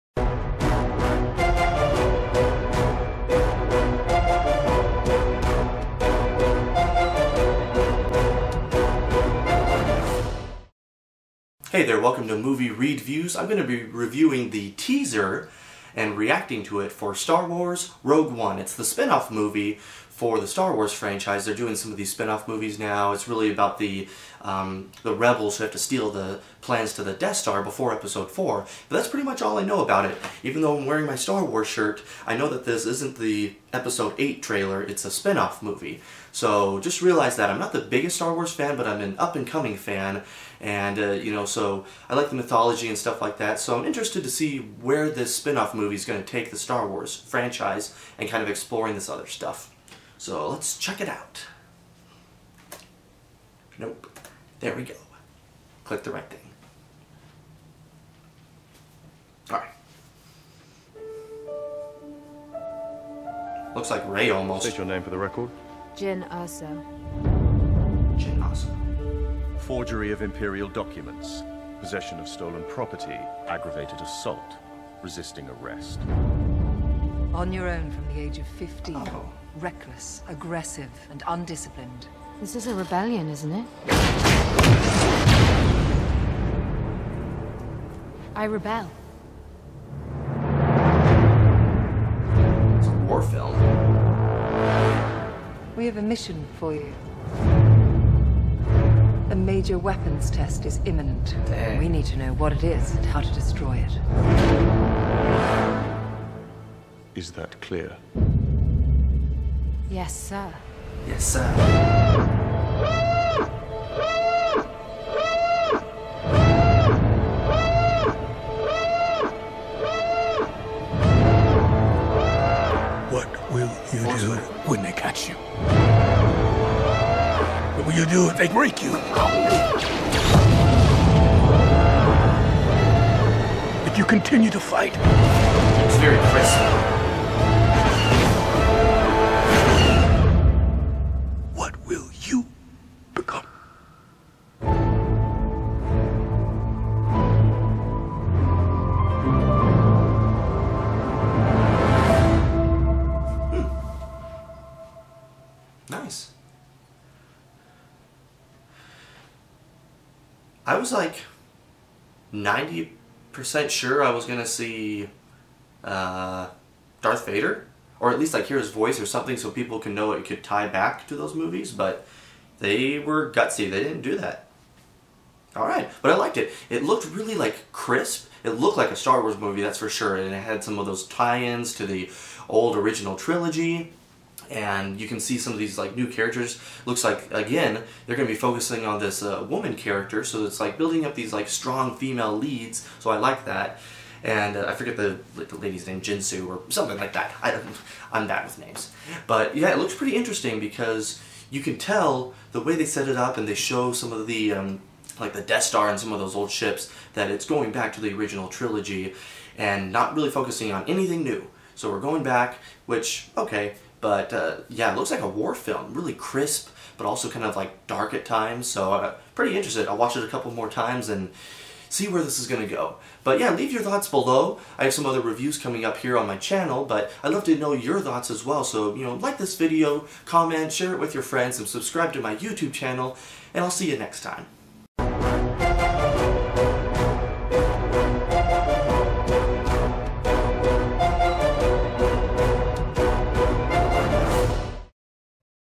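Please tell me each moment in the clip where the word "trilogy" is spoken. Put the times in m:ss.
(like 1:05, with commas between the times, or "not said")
3:03, 3:28.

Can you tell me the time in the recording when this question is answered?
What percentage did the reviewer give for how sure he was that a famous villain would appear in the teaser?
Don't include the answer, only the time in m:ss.
2:42.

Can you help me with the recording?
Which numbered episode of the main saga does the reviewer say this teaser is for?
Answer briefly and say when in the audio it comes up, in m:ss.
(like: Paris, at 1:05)
Episode 8, at 0:33.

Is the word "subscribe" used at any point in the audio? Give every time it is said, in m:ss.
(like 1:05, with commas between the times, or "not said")
3:51.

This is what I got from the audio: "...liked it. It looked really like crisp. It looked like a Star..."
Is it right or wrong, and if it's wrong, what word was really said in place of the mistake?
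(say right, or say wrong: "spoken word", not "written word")
right.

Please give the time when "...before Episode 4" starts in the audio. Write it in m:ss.
0:27.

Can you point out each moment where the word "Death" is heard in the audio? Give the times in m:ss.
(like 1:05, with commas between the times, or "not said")
0:27, 3:25.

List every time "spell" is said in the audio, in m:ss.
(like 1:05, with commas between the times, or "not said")
not said.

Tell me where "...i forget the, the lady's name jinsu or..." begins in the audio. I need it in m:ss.
3:14.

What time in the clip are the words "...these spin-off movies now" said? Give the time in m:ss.
0:21.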